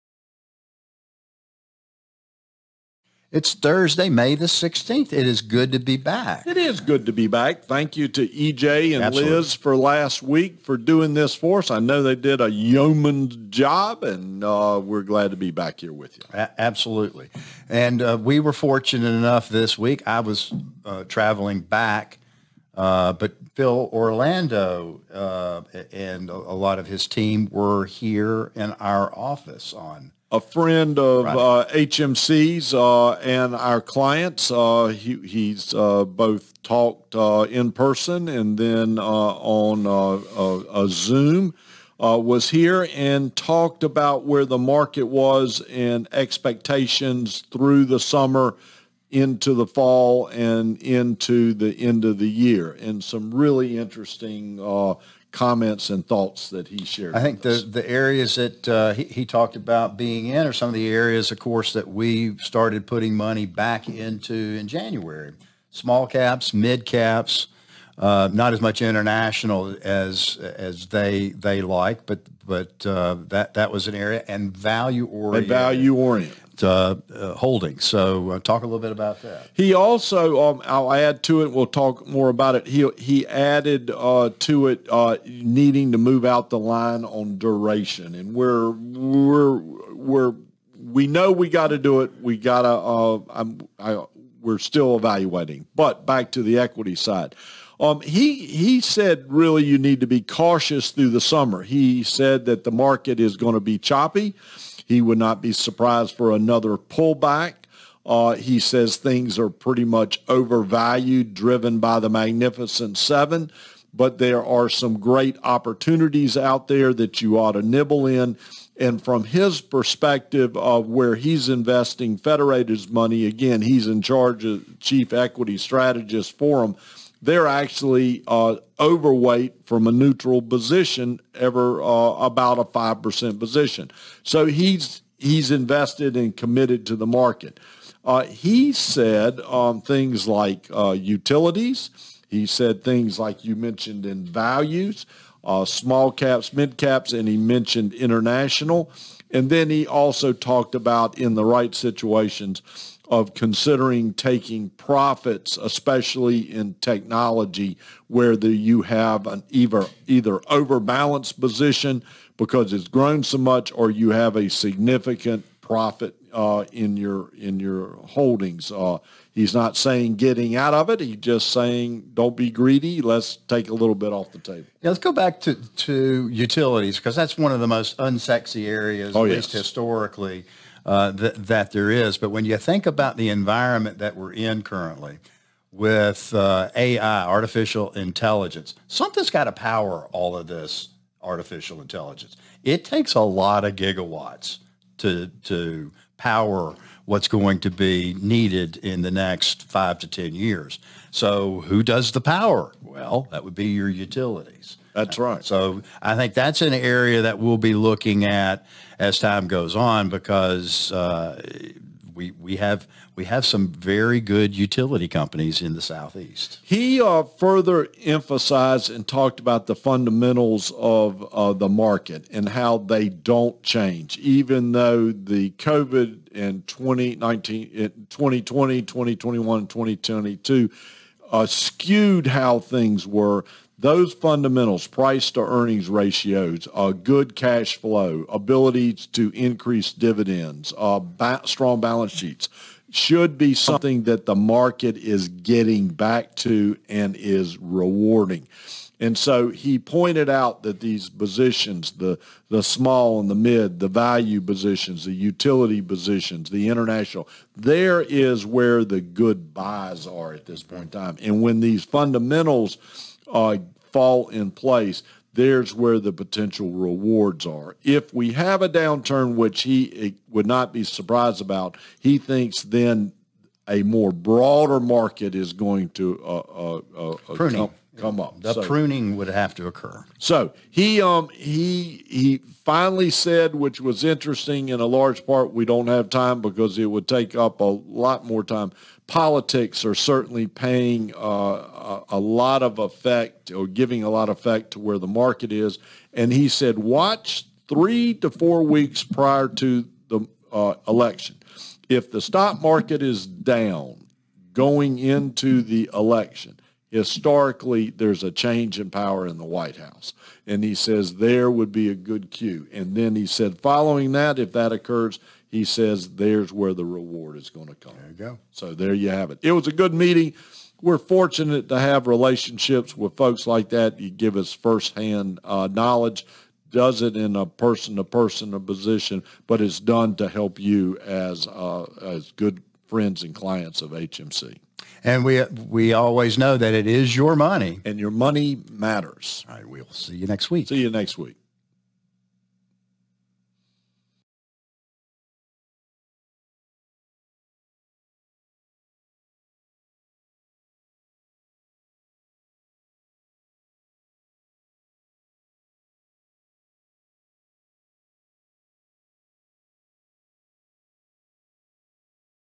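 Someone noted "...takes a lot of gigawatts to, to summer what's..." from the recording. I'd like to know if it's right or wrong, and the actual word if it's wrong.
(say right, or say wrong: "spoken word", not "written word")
wrong: "power", not "summer".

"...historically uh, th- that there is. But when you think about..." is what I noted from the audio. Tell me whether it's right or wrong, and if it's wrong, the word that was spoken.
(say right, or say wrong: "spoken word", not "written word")
right.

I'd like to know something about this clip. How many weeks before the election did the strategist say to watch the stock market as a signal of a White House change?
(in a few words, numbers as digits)
3 to 4 weeks.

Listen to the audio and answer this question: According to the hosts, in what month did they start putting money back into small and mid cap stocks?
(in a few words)
January.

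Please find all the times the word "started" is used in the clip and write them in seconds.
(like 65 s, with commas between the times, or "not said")
62 s.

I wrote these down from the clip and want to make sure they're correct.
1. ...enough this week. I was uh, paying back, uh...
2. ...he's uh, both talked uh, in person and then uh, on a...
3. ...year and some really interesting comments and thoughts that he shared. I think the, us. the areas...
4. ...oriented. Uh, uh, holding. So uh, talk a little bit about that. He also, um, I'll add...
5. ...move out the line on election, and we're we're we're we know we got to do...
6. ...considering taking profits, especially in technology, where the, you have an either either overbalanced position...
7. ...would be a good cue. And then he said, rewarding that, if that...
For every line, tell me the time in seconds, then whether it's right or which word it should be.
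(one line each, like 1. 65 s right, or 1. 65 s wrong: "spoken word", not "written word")
1. 19 s wrong: "traveling", not "paying"
2. 35 s right
3. 52 s right
4. 75 s right
5. 85 s wrong: "duration", not "election"
6. 153 s right
7. 311 s wrong: "following", not "rewarding".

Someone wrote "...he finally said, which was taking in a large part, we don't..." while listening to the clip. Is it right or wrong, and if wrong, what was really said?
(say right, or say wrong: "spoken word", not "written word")
wrong: "interesting", not "taking".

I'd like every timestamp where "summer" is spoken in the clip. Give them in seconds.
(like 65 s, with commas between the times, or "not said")
47 s, 101 s.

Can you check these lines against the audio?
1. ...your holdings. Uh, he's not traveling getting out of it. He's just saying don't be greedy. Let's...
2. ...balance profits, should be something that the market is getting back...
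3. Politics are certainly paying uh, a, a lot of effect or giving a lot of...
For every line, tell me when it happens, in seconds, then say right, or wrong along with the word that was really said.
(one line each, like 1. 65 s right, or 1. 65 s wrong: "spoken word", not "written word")
1. 167 s wrong: "saying", not "traveling"
2. 241 s wrong: "sheets", not "profits"
3. 289 s right.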